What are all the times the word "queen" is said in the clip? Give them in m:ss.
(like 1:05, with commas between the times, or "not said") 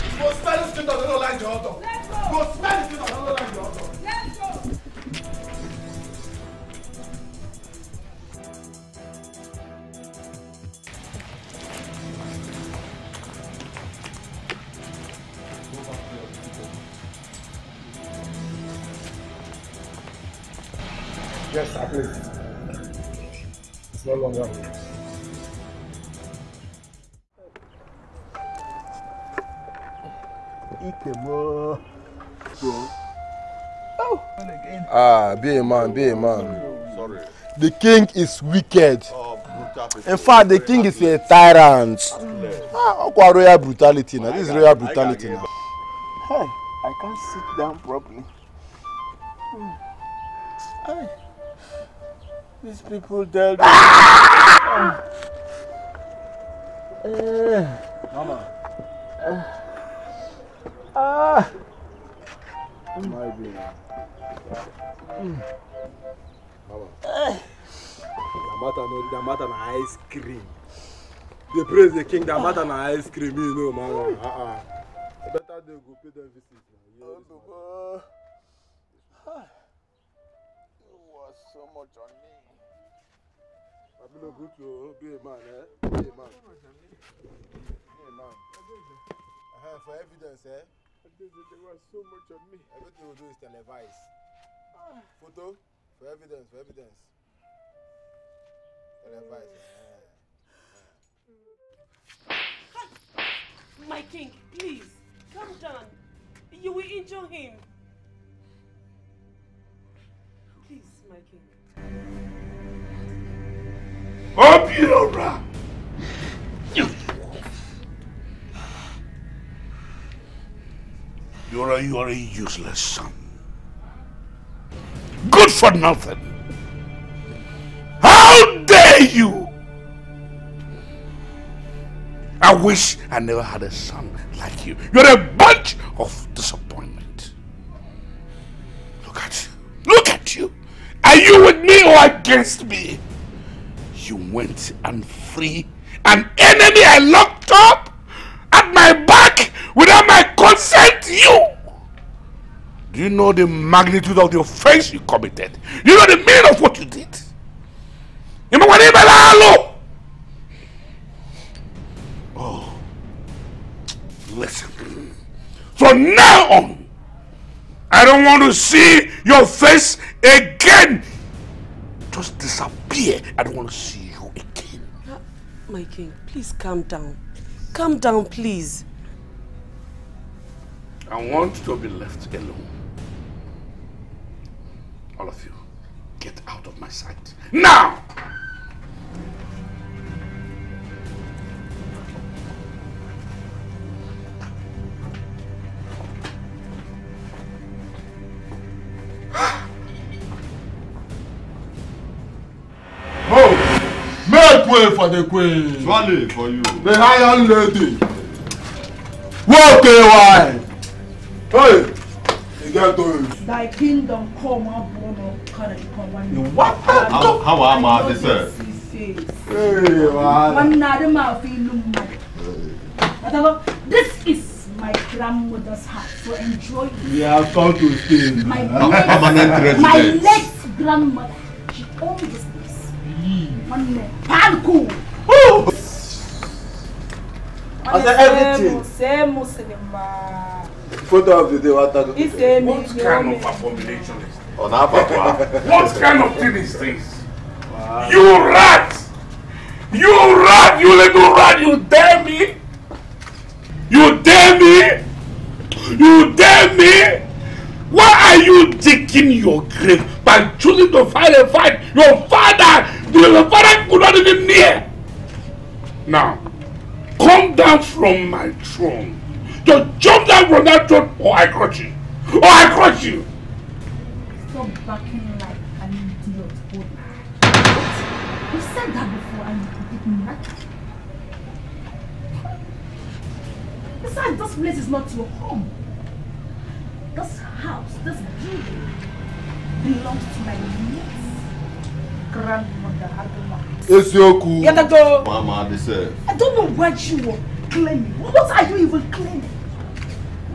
3:25.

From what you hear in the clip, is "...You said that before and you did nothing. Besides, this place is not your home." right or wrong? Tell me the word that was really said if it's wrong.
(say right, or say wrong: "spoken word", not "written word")
right.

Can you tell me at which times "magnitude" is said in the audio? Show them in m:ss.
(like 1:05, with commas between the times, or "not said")
2:33.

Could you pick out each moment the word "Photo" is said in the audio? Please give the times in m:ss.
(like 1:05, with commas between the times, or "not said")
1:35, 4:01.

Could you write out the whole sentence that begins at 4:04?
Oh, what kind of thing is this?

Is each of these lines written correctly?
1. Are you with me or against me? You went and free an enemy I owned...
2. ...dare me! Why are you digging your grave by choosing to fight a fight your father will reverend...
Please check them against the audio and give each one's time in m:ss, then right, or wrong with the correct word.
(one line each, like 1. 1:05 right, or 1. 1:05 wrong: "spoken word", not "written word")
1. 2:21 wrong: "locked", not "owned"
2. 4:16 right.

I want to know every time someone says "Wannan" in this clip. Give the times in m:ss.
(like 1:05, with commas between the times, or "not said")
3:53.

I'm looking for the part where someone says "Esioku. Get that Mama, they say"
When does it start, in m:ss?
4:53.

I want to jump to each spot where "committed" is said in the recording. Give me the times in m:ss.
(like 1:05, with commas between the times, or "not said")
2:35.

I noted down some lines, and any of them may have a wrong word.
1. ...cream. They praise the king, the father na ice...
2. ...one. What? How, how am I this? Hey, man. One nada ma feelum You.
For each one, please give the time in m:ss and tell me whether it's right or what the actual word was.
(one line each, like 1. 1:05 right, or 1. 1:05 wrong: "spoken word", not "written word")
1. 1:10 wrong: "matter", not "father"
2. 3:36 wrong: "Whatever", not "You".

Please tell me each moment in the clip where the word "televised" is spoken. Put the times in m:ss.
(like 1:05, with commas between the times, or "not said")
1:33, 1:39.